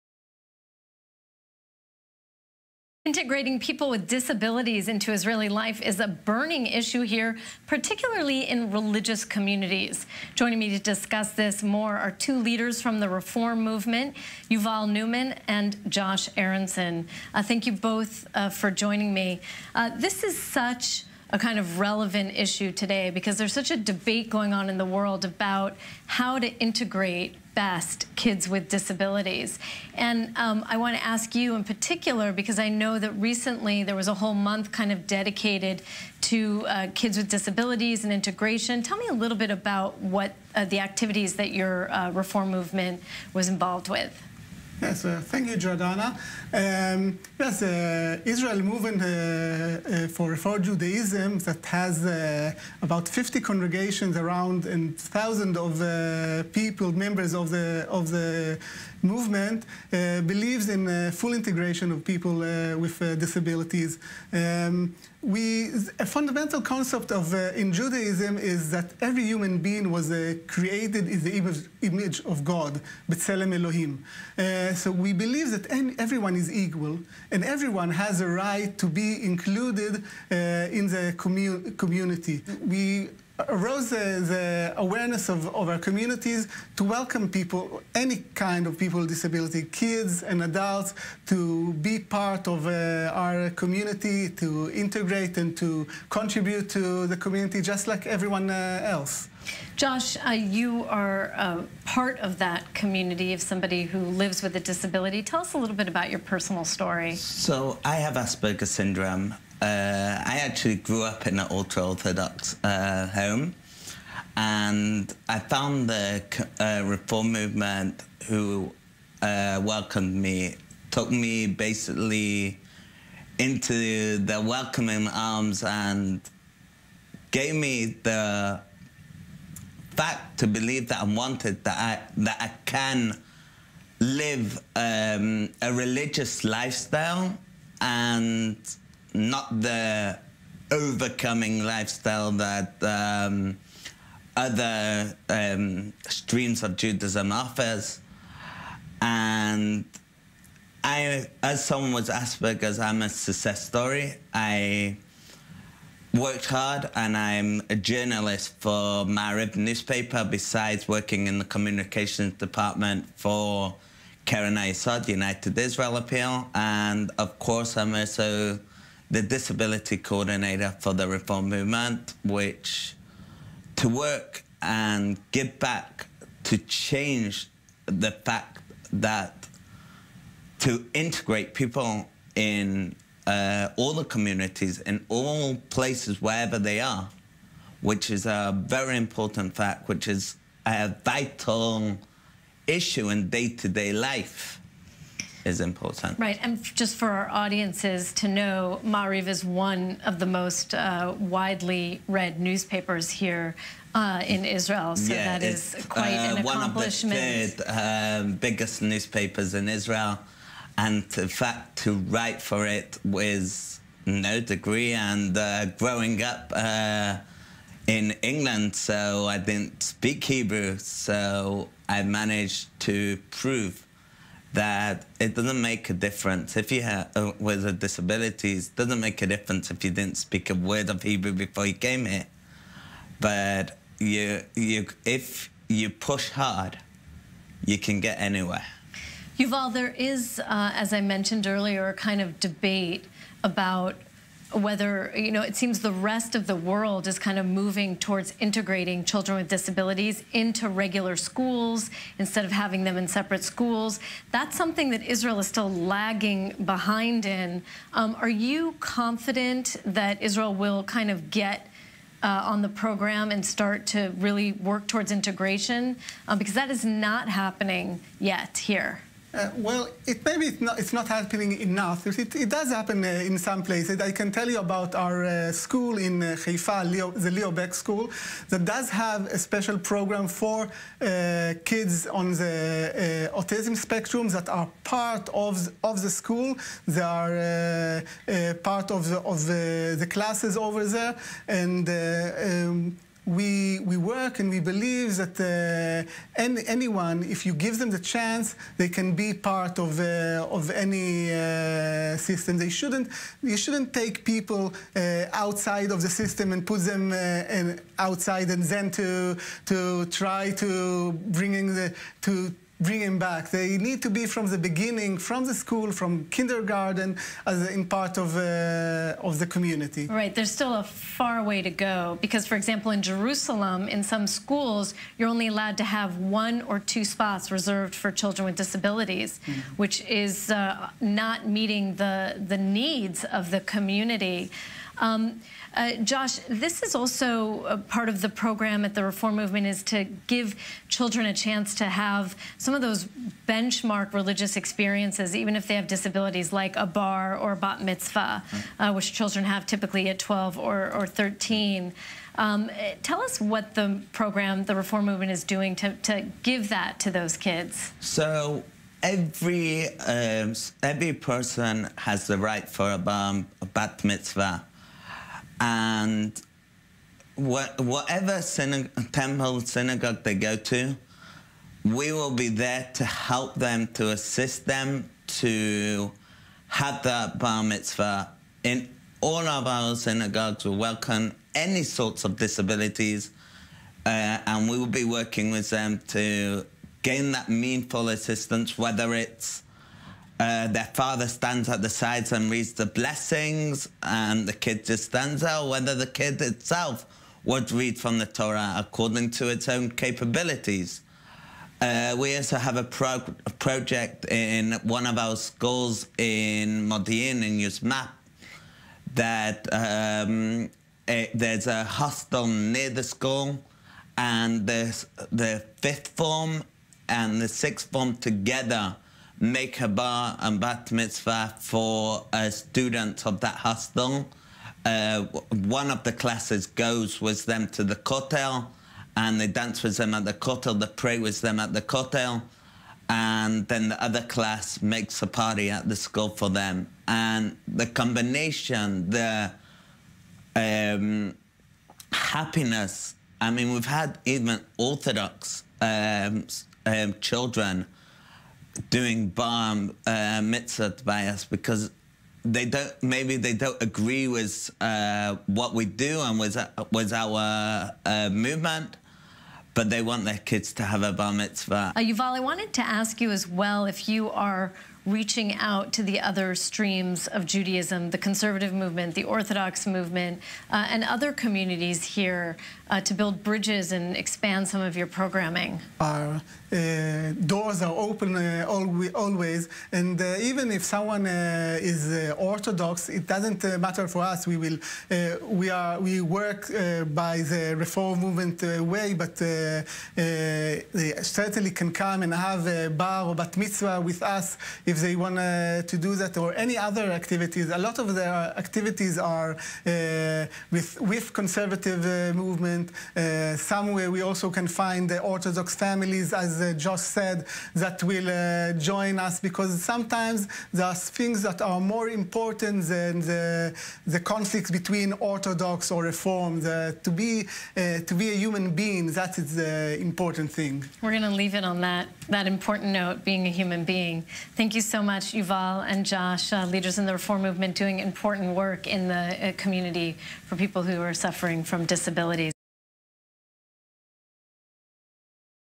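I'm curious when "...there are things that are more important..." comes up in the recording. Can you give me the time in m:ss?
8:30.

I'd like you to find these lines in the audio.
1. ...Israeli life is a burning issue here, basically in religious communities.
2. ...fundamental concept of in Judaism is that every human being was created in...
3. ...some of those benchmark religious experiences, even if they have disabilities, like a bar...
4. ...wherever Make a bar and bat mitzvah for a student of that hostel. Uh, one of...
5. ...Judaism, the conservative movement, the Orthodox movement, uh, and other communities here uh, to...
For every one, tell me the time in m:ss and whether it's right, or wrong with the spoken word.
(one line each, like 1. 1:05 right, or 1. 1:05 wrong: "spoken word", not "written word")
1. 0:05 wrong: "particularly", not "basically"
2. 1:06 right
3. 5:42 right
4. 6:58 wrong: "together", not "wherever"
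5. 7:47 right.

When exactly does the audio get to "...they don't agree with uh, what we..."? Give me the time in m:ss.
7:33.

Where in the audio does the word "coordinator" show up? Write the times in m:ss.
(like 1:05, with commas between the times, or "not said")
2:49.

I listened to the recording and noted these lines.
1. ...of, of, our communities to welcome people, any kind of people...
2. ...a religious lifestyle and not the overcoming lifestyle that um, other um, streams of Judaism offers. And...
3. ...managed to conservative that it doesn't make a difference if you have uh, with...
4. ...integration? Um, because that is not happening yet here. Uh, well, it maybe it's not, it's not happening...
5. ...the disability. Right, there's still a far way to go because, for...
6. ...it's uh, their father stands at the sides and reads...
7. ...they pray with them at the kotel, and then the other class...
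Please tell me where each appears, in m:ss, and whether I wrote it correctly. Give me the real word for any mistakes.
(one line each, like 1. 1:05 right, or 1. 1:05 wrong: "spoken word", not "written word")
1. 1:25 right
2. 2:15 right
3. 3:42 wrong: "prove", not "conservative"
4. 4:25 right
5. 5:19 wrong: "community", not "disability"
6. 6:29 right
7. 7:10 right.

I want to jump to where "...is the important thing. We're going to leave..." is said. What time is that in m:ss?
8:39.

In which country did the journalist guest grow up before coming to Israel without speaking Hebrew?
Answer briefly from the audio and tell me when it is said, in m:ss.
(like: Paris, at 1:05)
England, at 3:38.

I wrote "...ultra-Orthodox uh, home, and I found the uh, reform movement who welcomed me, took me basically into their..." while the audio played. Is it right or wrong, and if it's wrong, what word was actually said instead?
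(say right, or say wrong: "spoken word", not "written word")
right.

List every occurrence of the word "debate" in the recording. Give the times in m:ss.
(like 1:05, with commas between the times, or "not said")
0:23, 4:02.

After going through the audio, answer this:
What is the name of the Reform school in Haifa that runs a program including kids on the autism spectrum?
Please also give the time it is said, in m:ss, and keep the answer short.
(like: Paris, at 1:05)
Leo Baeck School, at 4:37.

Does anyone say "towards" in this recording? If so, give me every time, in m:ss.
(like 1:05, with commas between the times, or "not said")
4:07, 4:24.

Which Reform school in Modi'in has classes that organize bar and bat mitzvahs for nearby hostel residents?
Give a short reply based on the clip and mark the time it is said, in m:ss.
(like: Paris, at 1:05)
Yozma, at 6:47.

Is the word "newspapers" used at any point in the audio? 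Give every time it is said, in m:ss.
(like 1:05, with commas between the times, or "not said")
2:39, 3:22, 3:28.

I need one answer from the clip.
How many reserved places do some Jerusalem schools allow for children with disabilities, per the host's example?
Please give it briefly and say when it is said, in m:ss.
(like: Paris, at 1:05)
1 or 2, at 5:26.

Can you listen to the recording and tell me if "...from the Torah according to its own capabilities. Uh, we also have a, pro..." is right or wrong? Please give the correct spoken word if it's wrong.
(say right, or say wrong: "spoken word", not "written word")
right.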